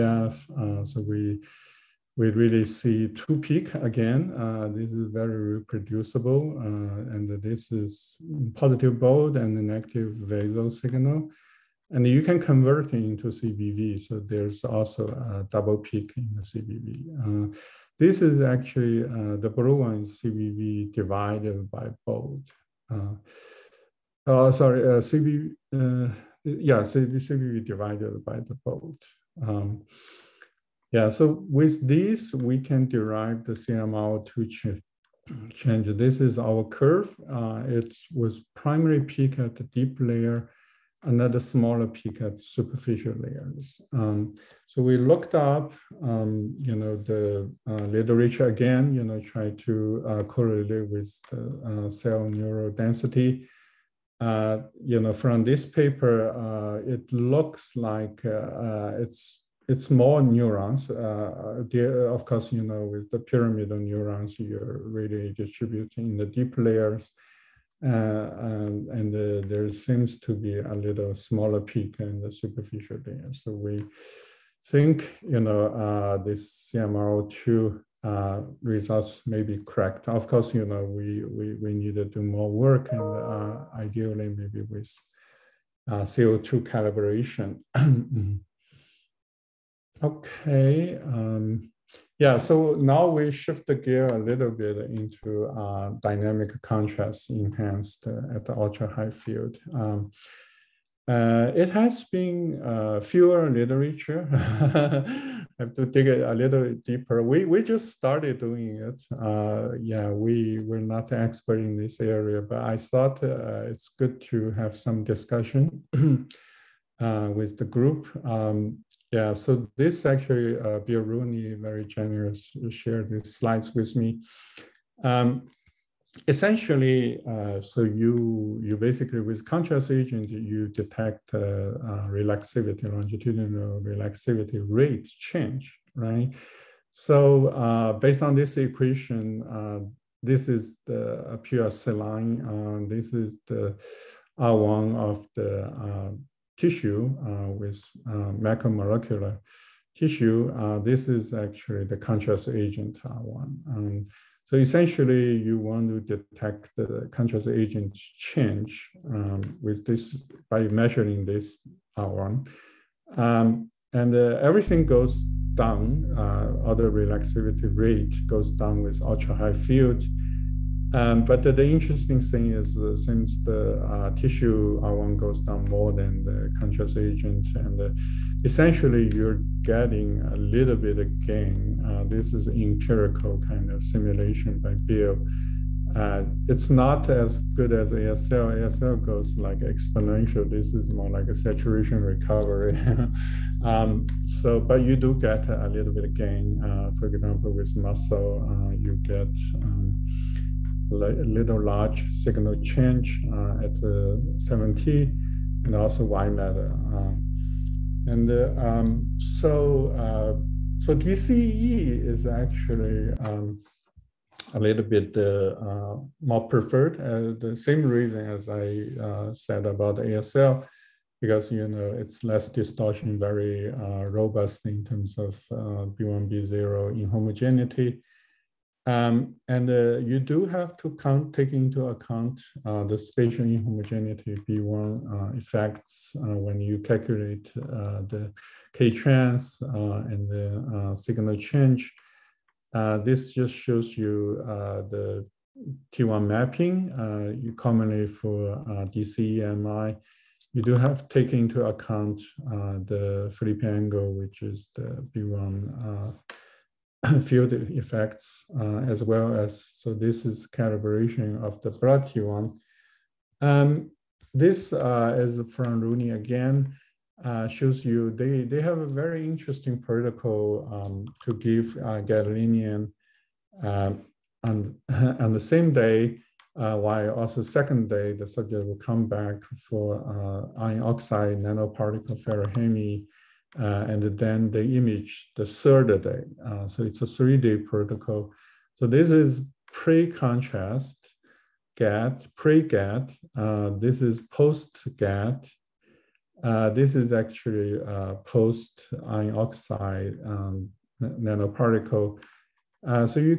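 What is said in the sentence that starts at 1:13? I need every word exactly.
So we think, you know, uh, this CMRO2 results may be correct.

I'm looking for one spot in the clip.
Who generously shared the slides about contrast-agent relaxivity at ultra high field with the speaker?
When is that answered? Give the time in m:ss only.
2:00.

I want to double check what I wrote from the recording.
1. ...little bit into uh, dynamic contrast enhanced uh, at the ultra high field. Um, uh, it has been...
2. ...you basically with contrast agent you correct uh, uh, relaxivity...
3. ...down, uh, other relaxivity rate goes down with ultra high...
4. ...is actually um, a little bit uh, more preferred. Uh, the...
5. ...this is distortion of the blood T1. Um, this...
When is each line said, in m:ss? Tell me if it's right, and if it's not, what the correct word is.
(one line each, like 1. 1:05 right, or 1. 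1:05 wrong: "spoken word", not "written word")
1. 1:34 right
2. 2:08 wrong: "detect", not "correct"
3. 2:45 right
4. 3:32 right
5. 4:19 wrong: "calibration", not "distortion".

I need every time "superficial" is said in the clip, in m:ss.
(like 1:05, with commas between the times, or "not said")
0:42, 1:12.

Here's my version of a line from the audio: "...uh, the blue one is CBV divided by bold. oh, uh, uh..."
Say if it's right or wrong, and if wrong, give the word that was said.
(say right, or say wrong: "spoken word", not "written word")
right.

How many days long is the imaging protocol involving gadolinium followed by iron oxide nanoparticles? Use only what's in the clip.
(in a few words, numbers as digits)
3.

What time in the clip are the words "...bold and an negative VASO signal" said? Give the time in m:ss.
0:08.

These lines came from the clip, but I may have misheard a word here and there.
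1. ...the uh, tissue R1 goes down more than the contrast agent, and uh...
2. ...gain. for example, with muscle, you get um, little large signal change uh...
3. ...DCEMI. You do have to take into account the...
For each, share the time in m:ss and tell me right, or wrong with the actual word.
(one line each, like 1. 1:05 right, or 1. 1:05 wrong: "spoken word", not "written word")
1. 2:53 right
2. 3:16 right
3. 4:08 right.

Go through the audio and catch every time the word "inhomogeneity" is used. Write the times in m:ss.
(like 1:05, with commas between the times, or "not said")
3:46, 3:53.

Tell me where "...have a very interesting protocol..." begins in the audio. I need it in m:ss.
4:28.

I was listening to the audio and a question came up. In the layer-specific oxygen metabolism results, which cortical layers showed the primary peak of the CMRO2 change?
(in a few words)
Deep layer.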